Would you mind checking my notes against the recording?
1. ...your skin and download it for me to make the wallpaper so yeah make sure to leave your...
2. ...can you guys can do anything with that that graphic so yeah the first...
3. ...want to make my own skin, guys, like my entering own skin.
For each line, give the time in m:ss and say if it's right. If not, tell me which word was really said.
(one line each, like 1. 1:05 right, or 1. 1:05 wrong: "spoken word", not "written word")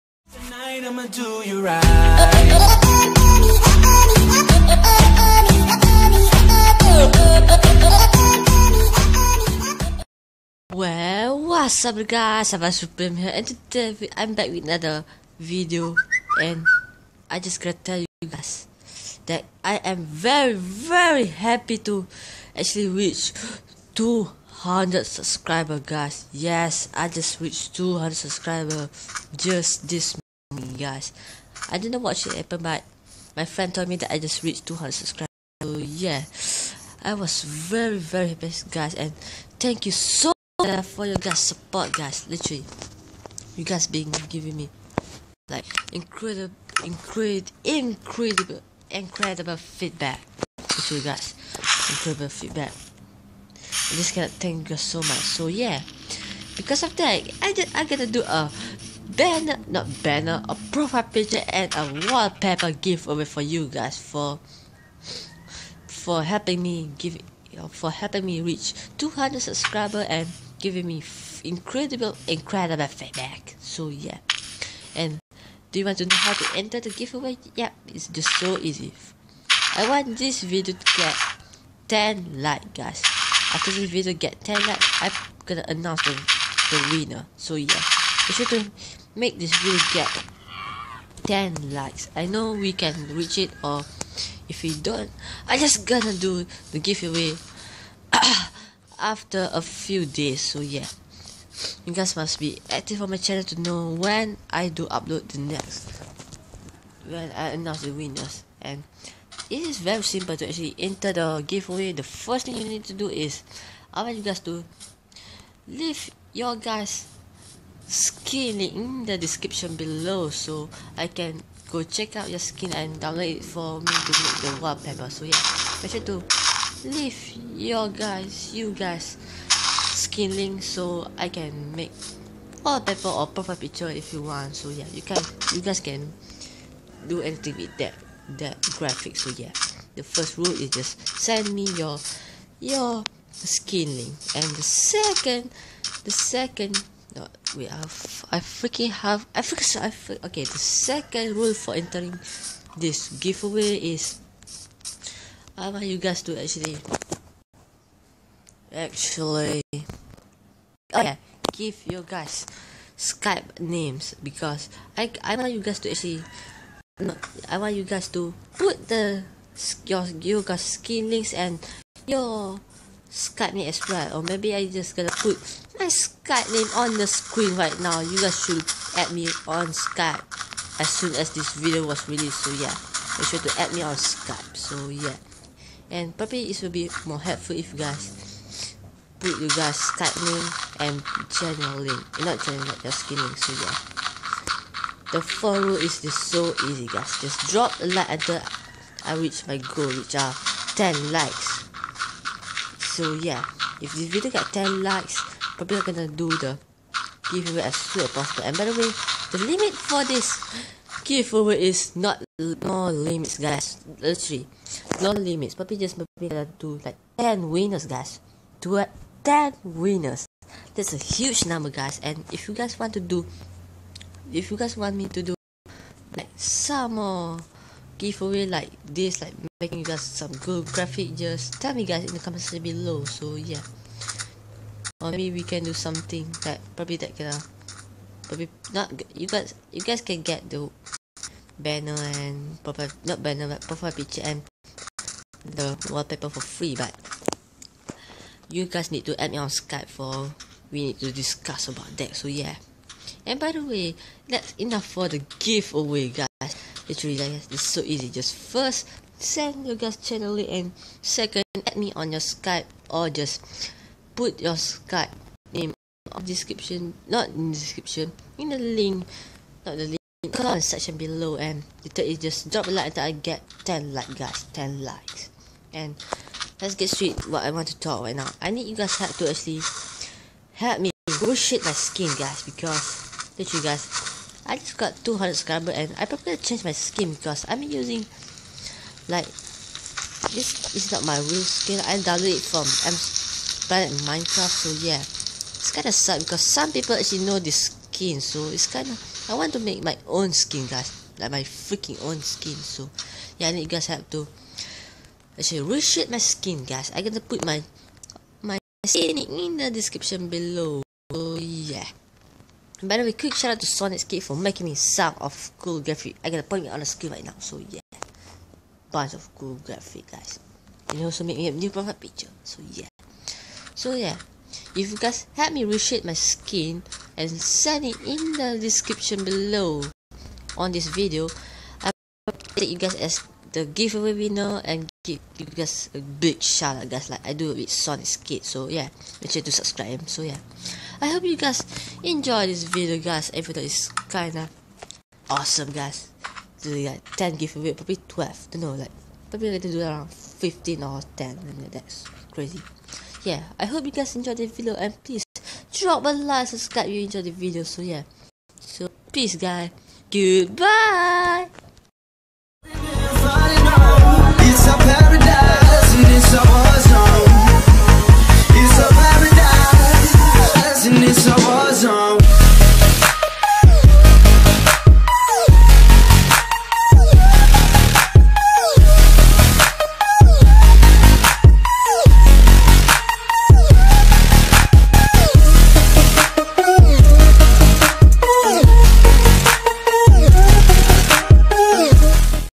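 1. 2:02 right
2. 2:15 right
3. 4:59 wrong: "freaking", not "entering".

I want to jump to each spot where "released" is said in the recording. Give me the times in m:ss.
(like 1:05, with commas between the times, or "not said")
3:02.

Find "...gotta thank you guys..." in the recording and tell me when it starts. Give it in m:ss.
0:54.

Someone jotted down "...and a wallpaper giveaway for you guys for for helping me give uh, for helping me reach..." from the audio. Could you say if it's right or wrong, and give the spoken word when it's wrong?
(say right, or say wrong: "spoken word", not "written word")
right.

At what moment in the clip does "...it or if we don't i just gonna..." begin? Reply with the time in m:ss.
1:33.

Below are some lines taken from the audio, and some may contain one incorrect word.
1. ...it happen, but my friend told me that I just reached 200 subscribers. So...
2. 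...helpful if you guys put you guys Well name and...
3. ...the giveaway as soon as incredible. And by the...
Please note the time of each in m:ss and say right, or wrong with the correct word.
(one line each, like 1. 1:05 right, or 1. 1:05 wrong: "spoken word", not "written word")
1. 0:32 right
2. 3:07 wrong: "Skype", not "Well"
3. 3:26 wrong: "possible", not "incredible".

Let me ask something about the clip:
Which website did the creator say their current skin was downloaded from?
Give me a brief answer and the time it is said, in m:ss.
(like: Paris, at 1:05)
Planet Minecraft, at 4:53.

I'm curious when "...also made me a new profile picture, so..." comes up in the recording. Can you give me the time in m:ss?
5:21.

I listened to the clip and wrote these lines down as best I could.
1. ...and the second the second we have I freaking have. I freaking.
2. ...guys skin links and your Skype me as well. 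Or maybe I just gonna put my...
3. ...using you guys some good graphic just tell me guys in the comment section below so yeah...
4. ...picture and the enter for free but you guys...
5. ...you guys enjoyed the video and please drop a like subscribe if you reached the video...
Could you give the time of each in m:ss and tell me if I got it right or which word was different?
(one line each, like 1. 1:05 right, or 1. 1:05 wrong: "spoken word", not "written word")
1. 2:24 right
2. 2:50 right
3. 3:49 wrong: "making", not "using"
4. 4:03 wrong: "wallpaper", not "enter"
5. 5:53 wrong: "enjoyed", not "reached".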